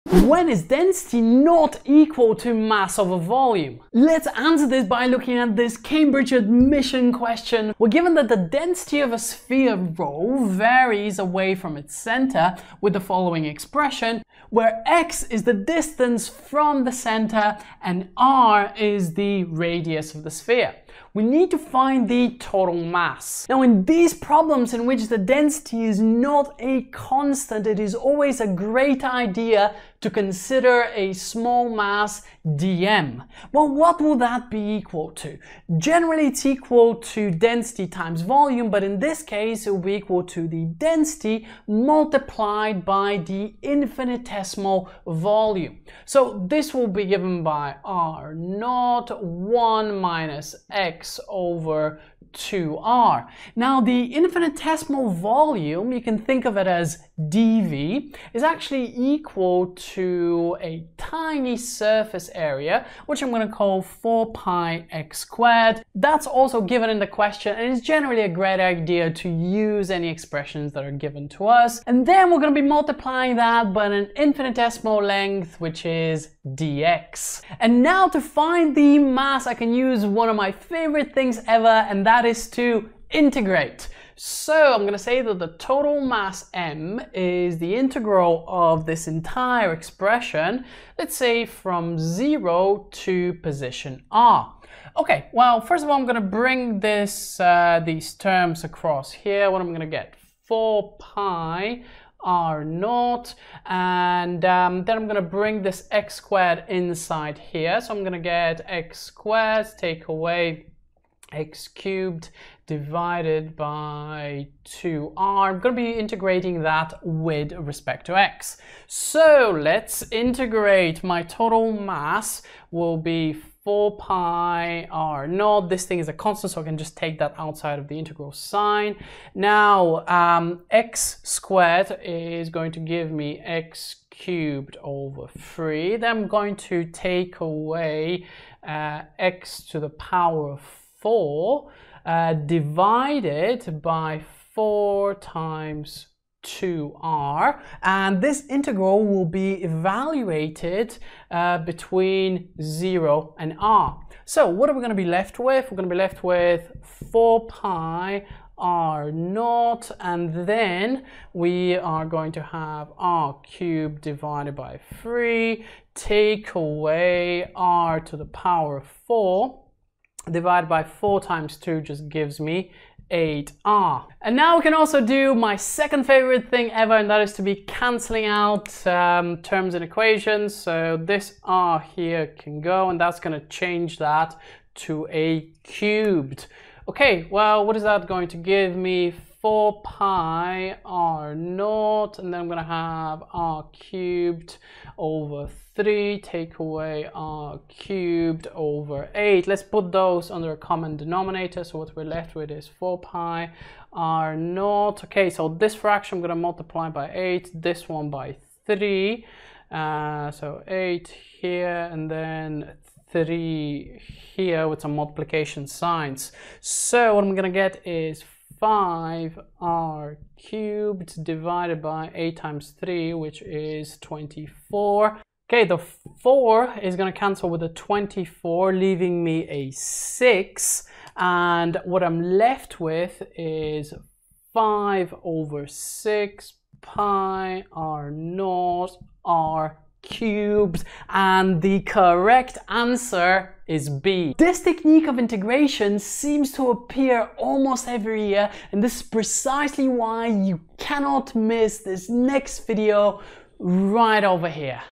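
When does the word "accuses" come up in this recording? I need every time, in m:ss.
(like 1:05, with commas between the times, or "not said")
not said.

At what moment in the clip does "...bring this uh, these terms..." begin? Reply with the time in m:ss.
1:36.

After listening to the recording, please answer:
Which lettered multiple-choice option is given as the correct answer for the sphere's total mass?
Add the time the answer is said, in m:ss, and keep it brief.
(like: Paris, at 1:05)
B, at 4:03.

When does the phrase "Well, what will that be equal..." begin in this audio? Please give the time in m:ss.
0:33.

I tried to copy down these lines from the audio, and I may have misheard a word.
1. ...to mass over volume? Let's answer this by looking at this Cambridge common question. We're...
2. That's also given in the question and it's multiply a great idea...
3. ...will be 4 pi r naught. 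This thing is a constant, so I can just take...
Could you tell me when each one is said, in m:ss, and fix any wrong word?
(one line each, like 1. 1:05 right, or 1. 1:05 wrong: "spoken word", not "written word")
1. 0:02 wrong: "admission", not "common"
2. 1:06 wrong: "generally", not "multiply"
3. 2:02 right.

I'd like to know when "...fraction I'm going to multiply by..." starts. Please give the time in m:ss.
3:25.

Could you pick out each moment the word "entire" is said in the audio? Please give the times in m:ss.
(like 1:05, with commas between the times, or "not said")
1:29.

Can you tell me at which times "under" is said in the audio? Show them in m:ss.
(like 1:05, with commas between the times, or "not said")
3:20.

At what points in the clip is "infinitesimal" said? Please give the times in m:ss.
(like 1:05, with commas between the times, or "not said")
0:43, 0:54, 1:14.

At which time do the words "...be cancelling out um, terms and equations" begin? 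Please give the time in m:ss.
2:57.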